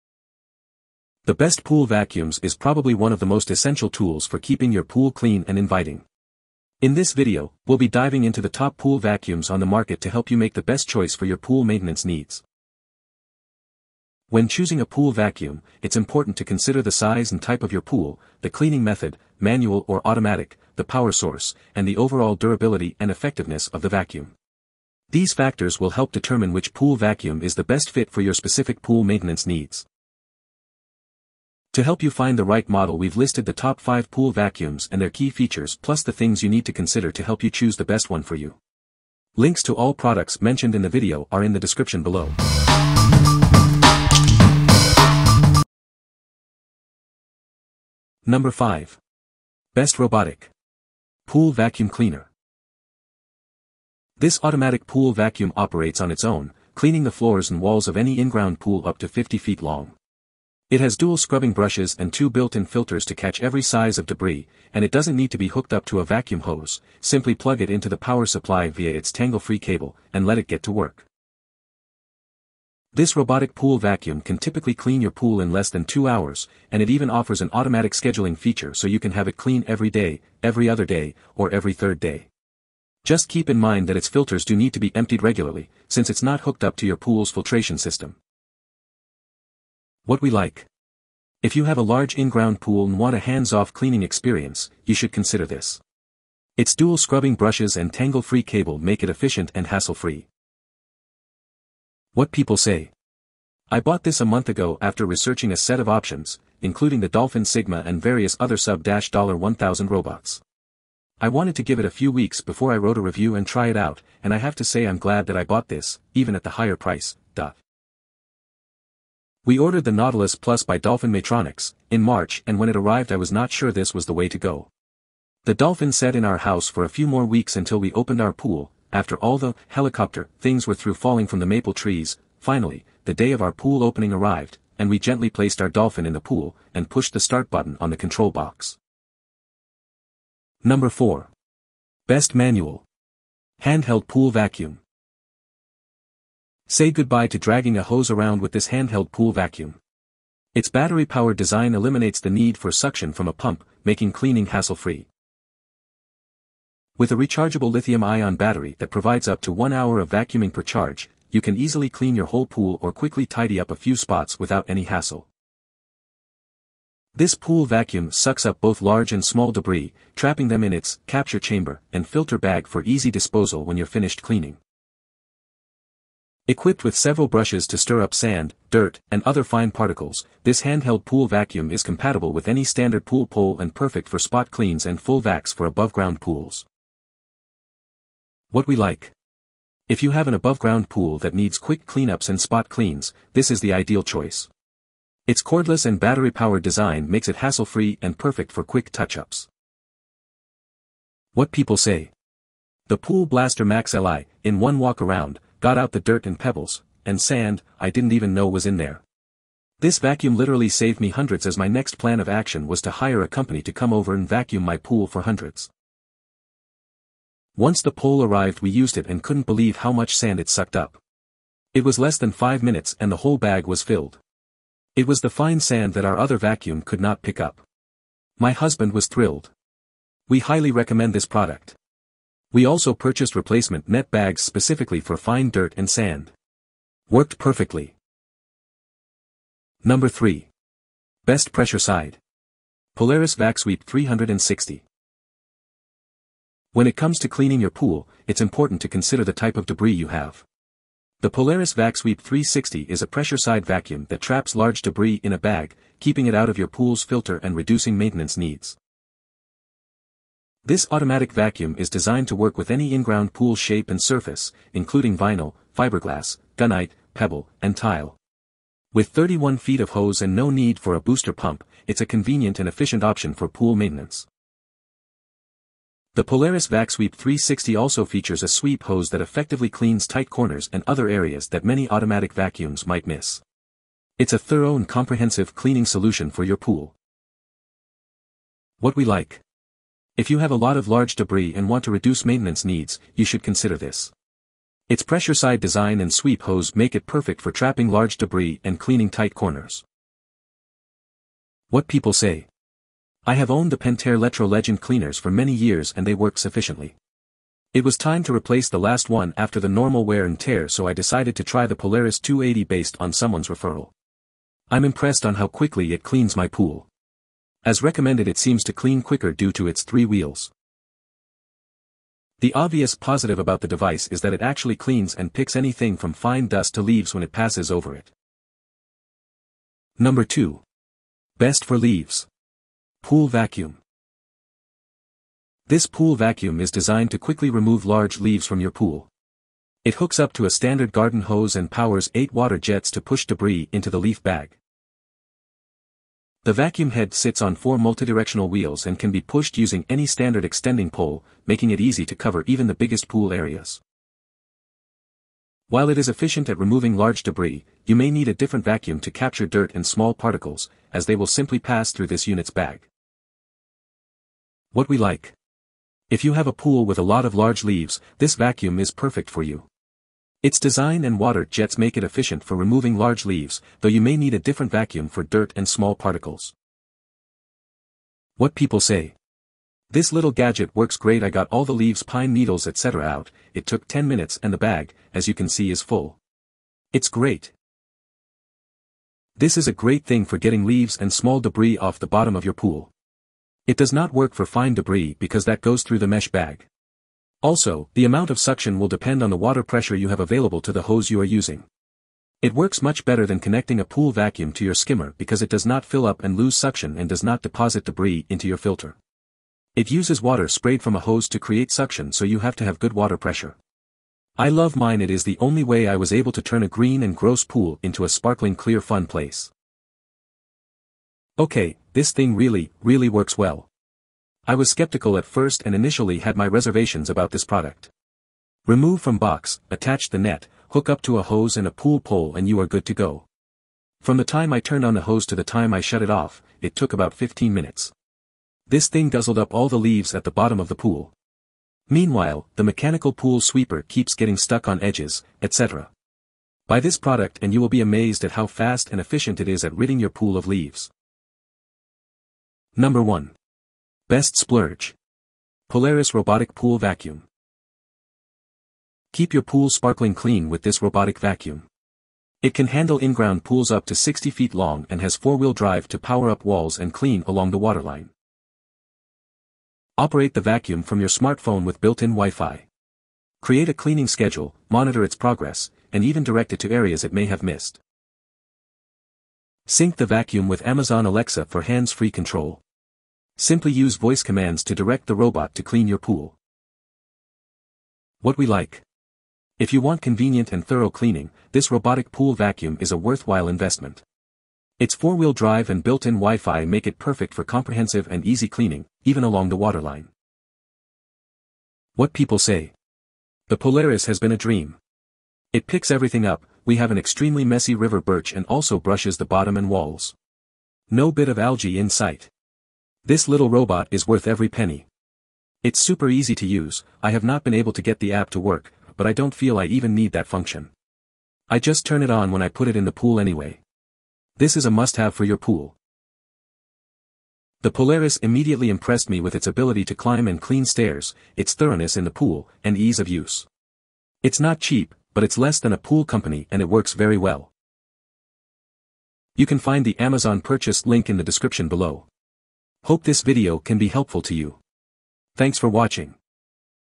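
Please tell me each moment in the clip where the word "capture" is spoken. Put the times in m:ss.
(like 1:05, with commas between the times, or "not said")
2:51, 5:59.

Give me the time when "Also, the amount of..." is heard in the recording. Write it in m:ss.
6:37.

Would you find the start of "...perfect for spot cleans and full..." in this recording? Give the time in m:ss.
3:03.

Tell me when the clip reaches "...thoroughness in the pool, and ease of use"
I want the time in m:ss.
8:51.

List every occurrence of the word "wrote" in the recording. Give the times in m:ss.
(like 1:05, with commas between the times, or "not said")
1:52.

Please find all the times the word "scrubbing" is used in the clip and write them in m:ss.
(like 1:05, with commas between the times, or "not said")
1:01, 1:36.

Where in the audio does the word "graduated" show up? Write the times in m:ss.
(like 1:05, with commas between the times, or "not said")
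not said.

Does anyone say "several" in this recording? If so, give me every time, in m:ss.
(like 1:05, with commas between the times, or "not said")
2:56.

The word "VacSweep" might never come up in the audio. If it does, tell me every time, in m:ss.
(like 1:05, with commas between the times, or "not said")
4:03, 4:11, 4:36.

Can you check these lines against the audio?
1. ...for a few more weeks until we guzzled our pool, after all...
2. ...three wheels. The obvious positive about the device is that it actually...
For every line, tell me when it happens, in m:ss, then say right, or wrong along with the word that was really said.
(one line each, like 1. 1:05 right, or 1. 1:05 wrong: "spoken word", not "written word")
1. 2:06 wrong: "opened", not "guzzled"
2. 5:19 right.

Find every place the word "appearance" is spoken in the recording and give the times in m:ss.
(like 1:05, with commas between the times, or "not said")
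not said.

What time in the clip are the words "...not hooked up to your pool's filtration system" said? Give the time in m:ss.
1:26.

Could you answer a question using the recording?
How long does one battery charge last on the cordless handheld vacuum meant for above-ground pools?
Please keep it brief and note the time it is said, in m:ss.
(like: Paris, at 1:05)
one hour, at 2:39.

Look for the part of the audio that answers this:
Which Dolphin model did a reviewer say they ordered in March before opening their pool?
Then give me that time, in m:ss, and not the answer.
1:59.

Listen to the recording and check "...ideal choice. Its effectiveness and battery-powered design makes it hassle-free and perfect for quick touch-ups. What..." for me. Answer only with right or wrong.
wrong.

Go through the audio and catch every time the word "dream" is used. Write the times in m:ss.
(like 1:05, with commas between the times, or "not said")
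8:24.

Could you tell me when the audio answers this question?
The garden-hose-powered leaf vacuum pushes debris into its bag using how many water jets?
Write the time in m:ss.
5:42.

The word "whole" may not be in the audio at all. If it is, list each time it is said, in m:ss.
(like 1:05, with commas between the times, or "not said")
2:42, 3:43.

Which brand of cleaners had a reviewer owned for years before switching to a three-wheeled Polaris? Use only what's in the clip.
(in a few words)
Pentair.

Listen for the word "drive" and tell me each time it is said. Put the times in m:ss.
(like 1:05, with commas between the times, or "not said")
7:45, 8:15.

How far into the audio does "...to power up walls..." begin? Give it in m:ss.
7:45.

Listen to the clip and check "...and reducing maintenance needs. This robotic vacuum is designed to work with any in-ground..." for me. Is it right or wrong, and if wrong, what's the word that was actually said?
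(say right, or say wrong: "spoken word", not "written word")
wrong: "automatic", not "robotic".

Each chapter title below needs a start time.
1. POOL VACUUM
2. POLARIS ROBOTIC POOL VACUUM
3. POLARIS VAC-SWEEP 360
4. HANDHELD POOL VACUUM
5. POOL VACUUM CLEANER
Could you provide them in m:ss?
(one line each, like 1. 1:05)
1. 5:28
2. 7:31
3. 3:58
4. 2:19
5. 0:47.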